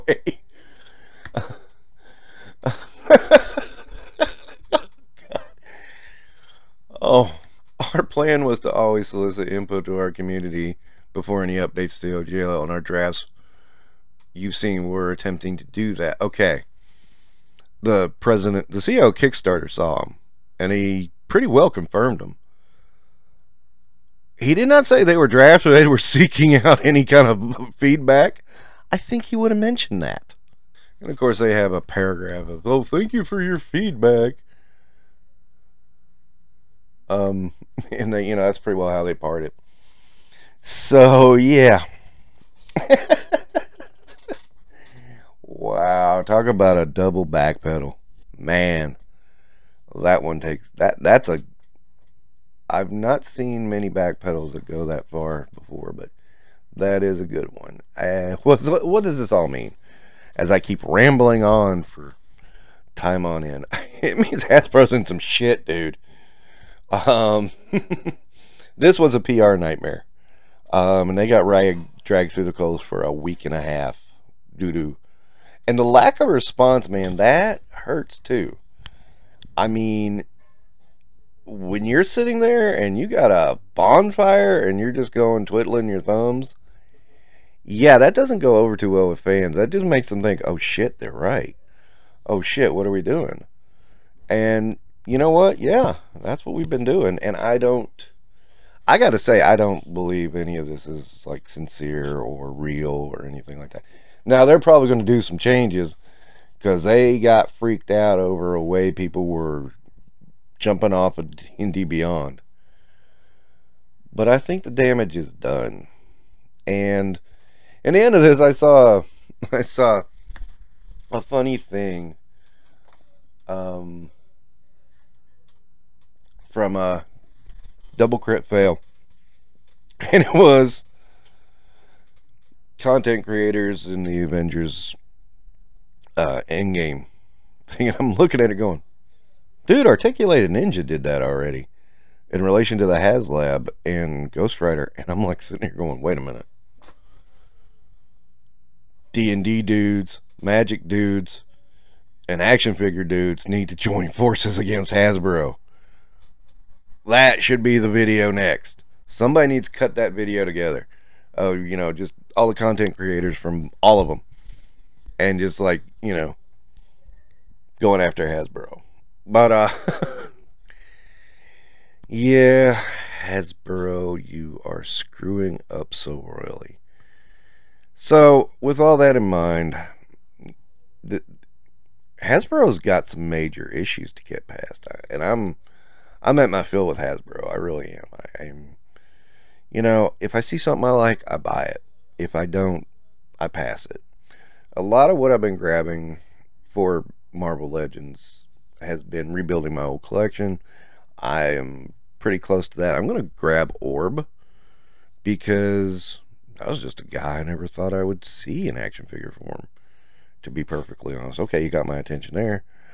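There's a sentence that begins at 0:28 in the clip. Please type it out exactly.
I think he would have mentioned that.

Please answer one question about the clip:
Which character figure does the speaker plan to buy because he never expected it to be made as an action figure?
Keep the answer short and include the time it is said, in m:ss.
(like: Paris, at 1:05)
Orb, at 3:23.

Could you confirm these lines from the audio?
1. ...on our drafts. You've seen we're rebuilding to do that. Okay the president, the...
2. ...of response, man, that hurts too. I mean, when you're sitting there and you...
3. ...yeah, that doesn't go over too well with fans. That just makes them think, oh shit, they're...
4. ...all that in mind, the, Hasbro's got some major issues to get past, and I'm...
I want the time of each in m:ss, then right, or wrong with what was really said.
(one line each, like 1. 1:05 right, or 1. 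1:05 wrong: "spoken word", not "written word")
1. 0:12 wrong: "attempting", not "rebuilding"
2. 1:16 right
3. 1:27 right
4. 2:58 right.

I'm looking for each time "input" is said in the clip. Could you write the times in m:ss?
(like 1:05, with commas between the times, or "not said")
0:09.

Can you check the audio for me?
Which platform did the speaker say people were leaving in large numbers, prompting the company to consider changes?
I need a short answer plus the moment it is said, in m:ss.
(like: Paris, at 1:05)
D&D Beyond, at 1:51.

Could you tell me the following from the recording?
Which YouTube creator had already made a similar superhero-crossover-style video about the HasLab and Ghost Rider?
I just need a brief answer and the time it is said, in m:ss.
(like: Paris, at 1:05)
Articulated Ninja, at 2:19.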